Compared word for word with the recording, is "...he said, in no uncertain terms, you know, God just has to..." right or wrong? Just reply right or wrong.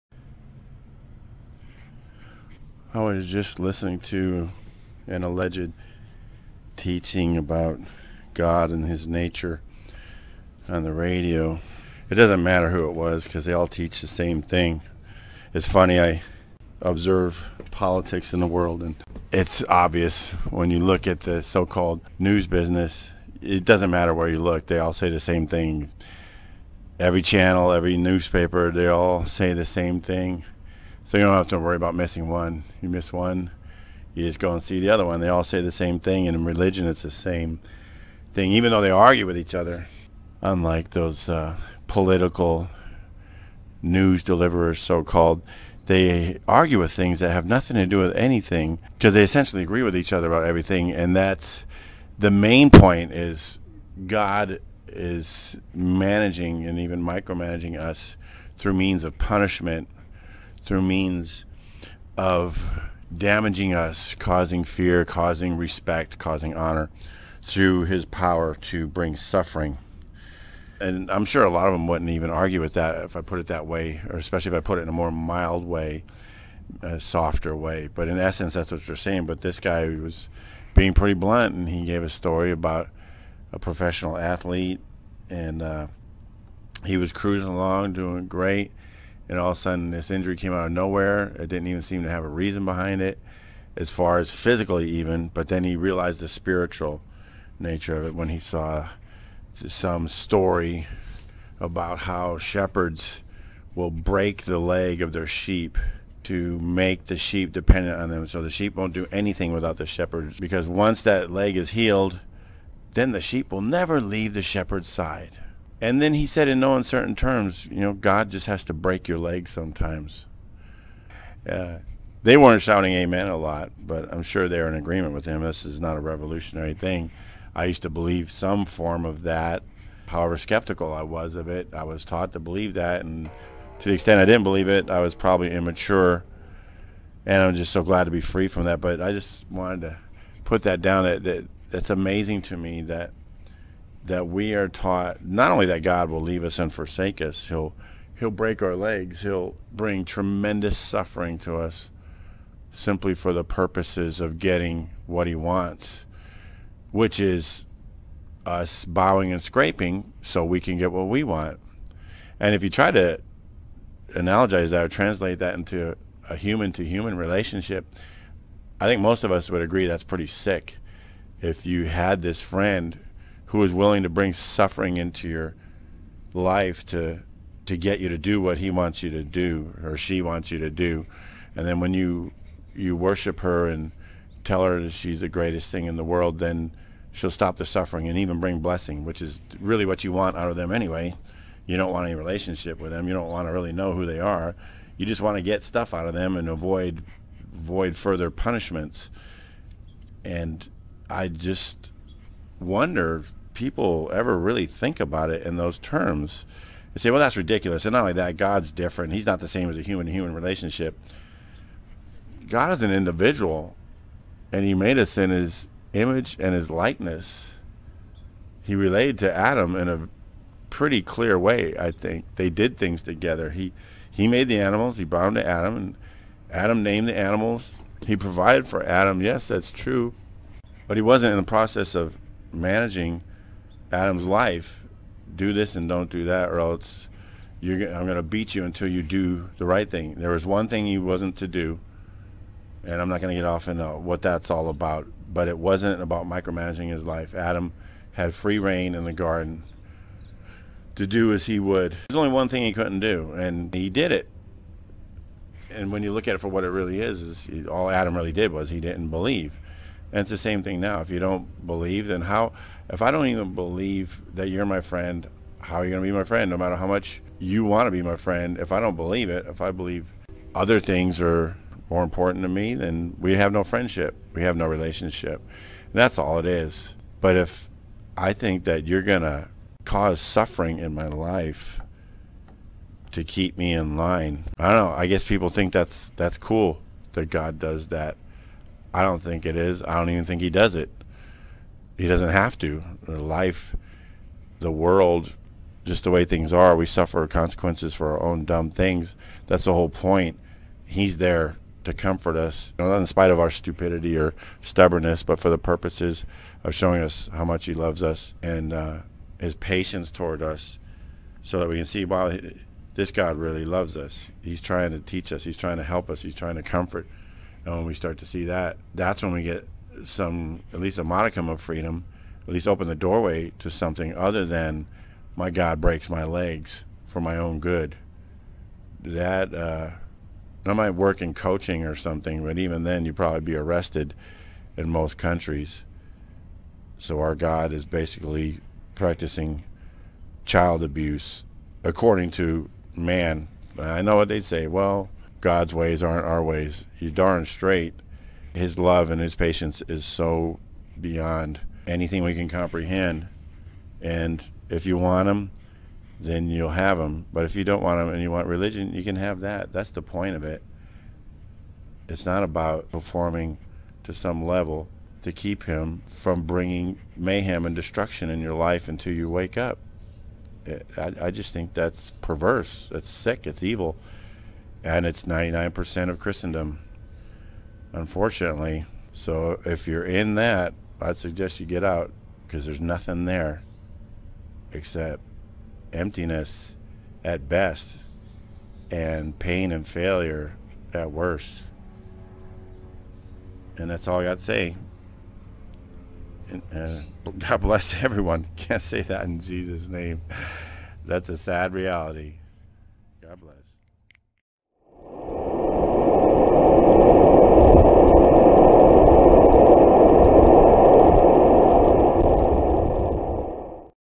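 right.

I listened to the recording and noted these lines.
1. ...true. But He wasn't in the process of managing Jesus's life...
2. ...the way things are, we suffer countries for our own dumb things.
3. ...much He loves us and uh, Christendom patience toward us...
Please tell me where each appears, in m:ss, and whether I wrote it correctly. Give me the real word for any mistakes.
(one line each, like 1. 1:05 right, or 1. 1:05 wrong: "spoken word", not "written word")
1. 3:49 wrong: "Adam", not "Jesus"
2. 4:56 wrong: "consequences", not "countries"
3. 5:07 wrong: "His", not "Christendom".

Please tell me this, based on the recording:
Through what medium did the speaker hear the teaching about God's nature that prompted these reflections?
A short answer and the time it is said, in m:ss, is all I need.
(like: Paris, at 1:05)
radio, at 0:10.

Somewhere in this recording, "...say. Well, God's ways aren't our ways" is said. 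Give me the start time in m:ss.
5:44.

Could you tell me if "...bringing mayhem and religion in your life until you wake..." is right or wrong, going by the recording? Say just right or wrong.
wrong.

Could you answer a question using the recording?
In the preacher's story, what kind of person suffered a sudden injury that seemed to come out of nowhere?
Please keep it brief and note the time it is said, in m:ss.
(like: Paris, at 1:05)
professional athlete, at 1:23.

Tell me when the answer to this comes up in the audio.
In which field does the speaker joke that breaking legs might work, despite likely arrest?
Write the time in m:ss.
5:31.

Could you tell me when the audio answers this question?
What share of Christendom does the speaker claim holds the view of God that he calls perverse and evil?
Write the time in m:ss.
6:15.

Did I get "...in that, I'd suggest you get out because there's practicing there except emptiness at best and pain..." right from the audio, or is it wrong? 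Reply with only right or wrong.
wrong.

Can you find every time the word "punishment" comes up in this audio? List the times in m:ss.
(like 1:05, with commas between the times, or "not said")
0:59, 3:18.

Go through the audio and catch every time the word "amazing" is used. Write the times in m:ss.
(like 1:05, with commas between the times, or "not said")
2:21.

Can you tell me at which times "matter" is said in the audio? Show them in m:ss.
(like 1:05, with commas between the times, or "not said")
0:12, 0:23, 4:26.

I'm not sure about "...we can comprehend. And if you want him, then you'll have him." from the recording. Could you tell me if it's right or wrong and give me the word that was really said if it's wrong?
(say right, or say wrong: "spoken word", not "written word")
right.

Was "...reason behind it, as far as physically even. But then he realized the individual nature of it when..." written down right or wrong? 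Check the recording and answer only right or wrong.
wrong.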